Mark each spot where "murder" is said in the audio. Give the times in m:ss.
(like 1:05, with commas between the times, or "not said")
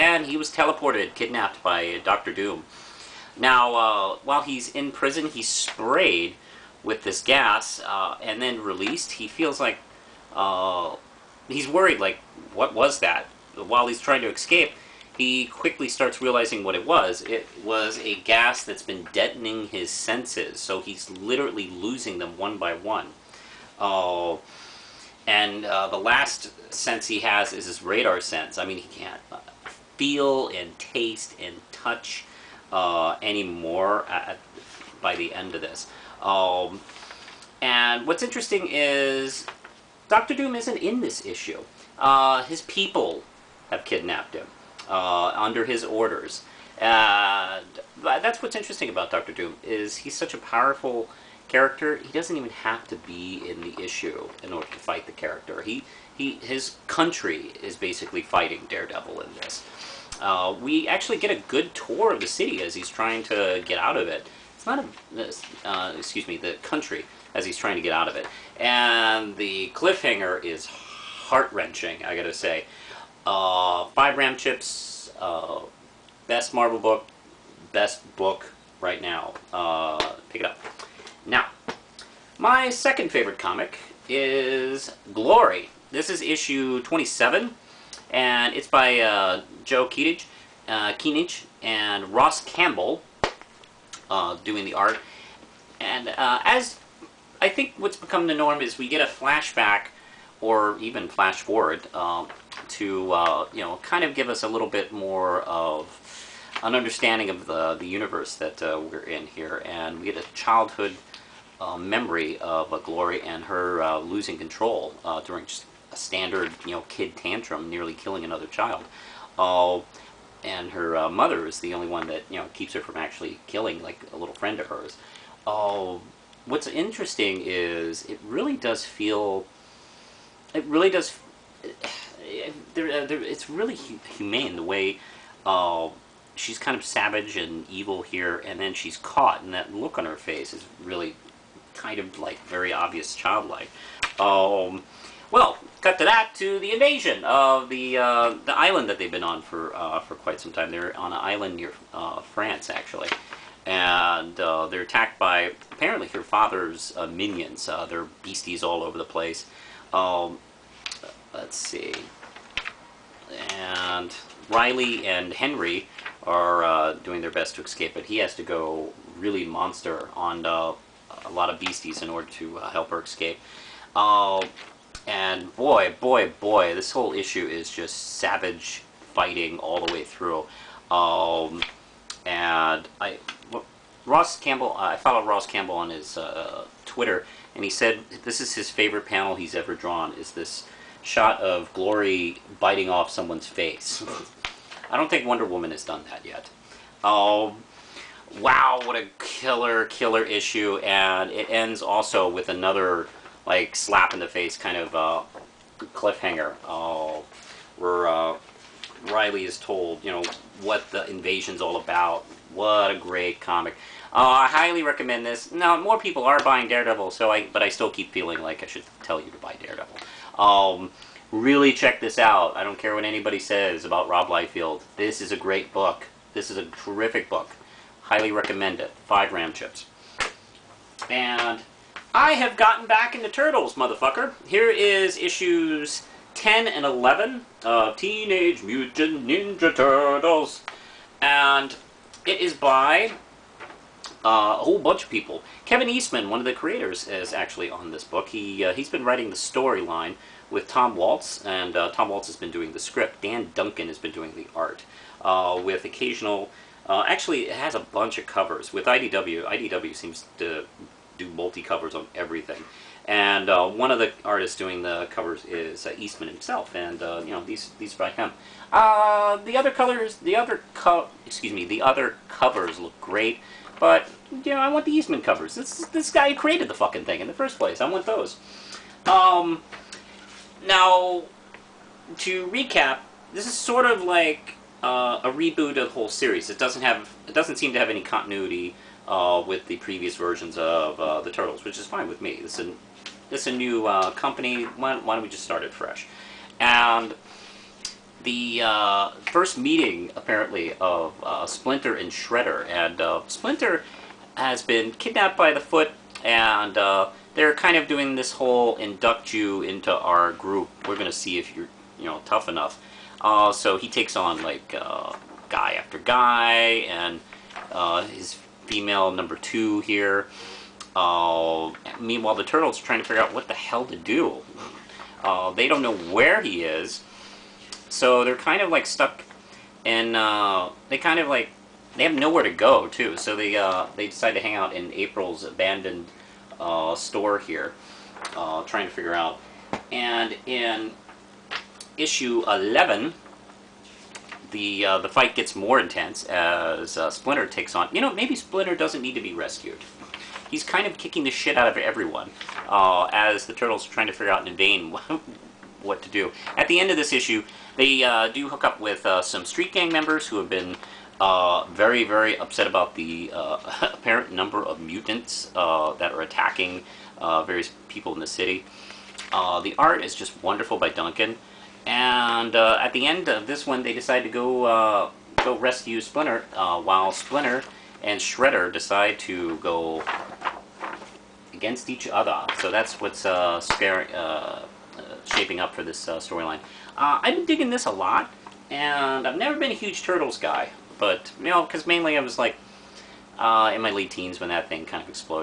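not said.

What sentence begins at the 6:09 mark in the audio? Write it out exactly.
the art is just wonderful by Duncan.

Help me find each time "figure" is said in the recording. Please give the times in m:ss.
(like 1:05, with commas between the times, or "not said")
5:23, 5:38, 5:54.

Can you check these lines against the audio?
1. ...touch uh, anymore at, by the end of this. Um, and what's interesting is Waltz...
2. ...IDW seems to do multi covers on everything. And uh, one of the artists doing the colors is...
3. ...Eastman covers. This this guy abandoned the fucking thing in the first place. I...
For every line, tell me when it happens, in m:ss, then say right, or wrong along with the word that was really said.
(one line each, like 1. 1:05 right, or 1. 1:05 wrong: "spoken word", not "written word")
1. 0:31 wrong: "Doctor", not "Waltz"
2. 4:19 wrong: "covers", not "colors"
3. 4:34 wrong: "created", not "abandoned".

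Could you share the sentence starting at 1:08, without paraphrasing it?
And the cliffhanger is heart-wrenching, I gotta say.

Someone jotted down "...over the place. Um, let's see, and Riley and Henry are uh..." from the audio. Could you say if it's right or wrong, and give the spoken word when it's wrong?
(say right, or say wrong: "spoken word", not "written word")
right.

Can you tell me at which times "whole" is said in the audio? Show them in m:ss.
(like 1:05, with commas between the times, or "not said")
2:56, 4:04, 4:45, 5:08.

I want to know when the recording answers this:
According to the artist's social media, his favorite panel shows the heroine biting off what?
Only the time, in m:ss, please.
3:13.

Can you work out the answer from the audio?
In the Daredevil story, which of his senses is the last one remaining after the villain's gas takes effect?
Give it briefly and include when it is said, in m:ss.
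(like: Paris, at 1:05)
Radar sense, at 0:27.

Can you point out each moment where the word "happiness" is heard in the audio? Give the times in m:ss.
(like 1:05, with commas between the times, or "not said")
not said.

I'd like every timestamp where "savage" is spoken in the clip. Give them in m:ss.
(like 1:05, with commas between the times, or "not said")
2:16, 2:58.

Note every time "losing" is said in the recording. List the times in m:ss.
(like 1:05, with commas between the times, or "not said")
0:21, 1:54.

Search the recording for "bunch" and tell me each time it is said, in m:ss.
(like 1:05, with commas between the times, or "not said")
4:04, 4:17.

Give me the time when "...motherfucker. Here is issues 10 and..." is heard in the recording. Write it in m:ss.
3:53.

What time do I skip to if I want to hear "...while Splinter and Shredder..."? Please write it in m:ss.
6:16.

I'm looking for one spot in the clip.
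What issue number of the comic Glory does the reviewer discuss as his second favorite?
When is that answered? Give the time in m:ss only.
1:26.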